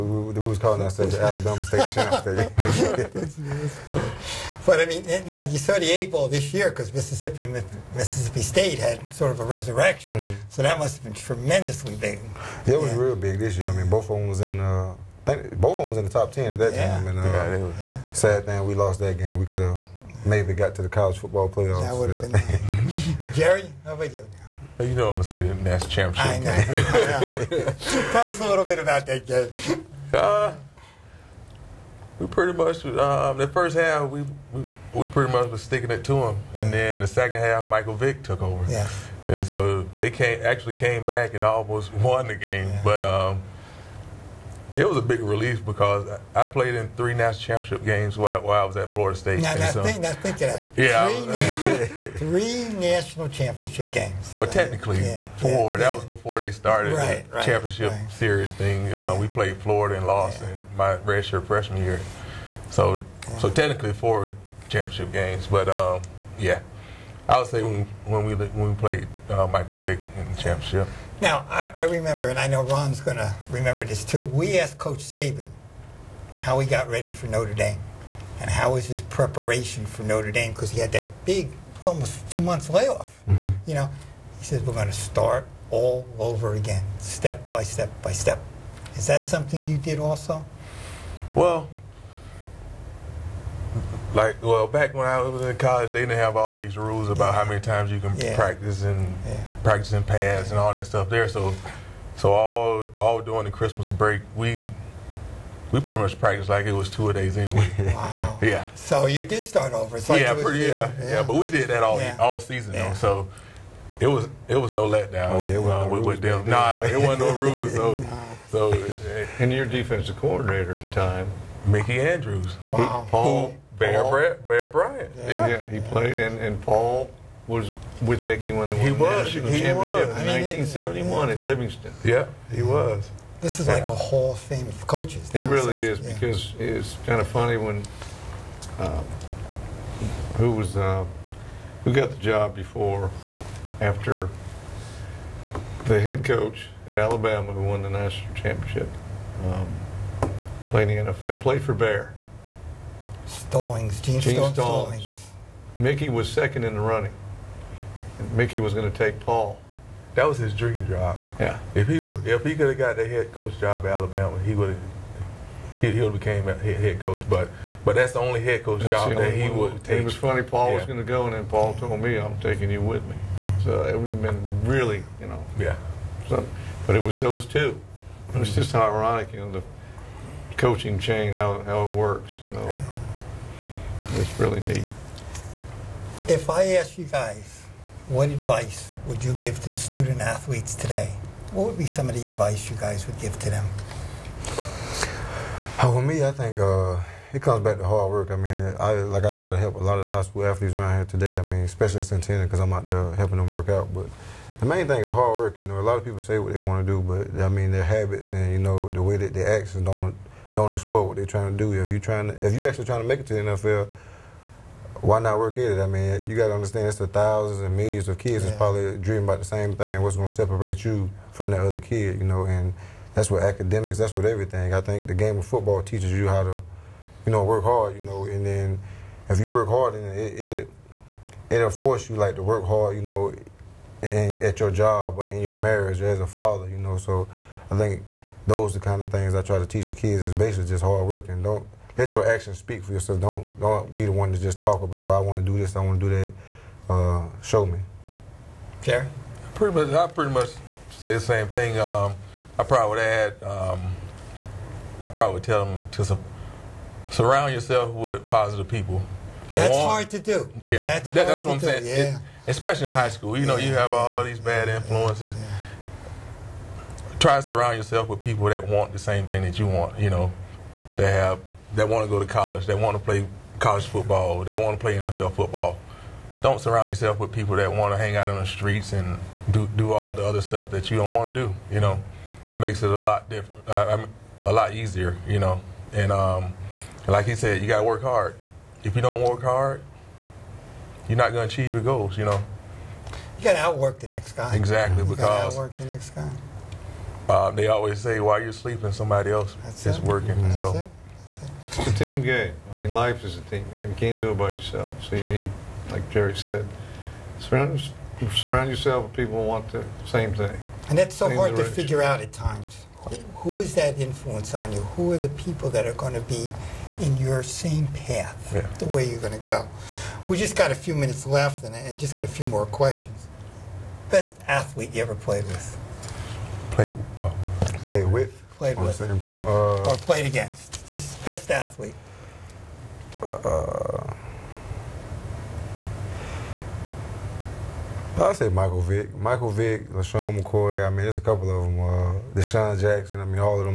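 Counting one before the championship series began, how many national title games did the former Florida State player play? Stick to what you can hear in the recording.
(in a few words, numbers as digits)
4.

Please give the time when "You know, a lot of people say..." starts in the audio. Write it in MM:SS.
03:25.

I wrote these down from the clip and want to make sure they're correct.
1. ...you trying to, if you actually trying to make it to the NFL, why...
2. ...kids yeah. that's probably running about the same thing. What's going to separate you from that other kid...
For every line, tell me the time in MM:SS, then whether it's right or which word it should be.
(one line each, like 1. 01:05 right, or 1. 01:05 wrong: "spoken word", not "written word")
1. 03:31 right
2. 03:38 wrong: "dreaming", not "running".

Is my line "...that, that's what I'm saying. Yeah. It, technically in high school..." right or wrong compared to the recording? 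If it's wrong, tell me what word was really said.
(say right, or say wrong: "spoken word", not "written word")
wrong: "especially", not "technically".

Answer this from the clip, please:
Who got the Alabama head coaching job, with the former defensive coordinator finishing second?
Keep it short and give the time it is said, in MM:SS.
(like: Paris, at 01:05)
Gene Stallings, at 02:34.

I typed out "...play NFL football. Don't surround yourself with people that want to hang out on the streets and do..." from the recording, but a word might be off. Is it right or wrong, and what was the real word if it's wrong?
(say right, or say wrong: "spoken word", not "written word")
right.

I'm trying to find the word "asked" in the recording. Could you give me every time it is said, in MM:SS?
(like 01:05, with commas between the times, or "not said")
01:14, 03:06.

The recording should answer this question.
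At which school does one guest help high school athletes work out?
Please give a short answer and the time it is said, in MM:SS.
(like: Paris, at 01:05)
Centennial, at 03:22.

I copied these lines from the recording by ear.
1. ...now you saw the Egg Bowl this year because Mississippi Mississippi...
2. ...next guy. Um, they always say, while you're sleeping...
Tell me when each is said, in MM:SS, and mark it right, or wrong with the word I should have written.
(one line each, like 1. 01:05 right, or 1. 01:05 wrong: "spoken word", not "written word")
1. 00:05 right
2. 04:55 right.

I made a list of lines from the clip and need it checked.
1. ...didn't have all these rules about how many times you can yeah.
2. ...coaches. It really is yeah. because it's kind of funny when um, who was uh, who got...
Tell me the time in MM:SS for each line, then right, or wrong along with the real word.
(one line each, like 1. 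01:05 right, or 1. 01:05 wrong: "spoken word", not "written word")
1. 01:36 right
2. 02:14 right.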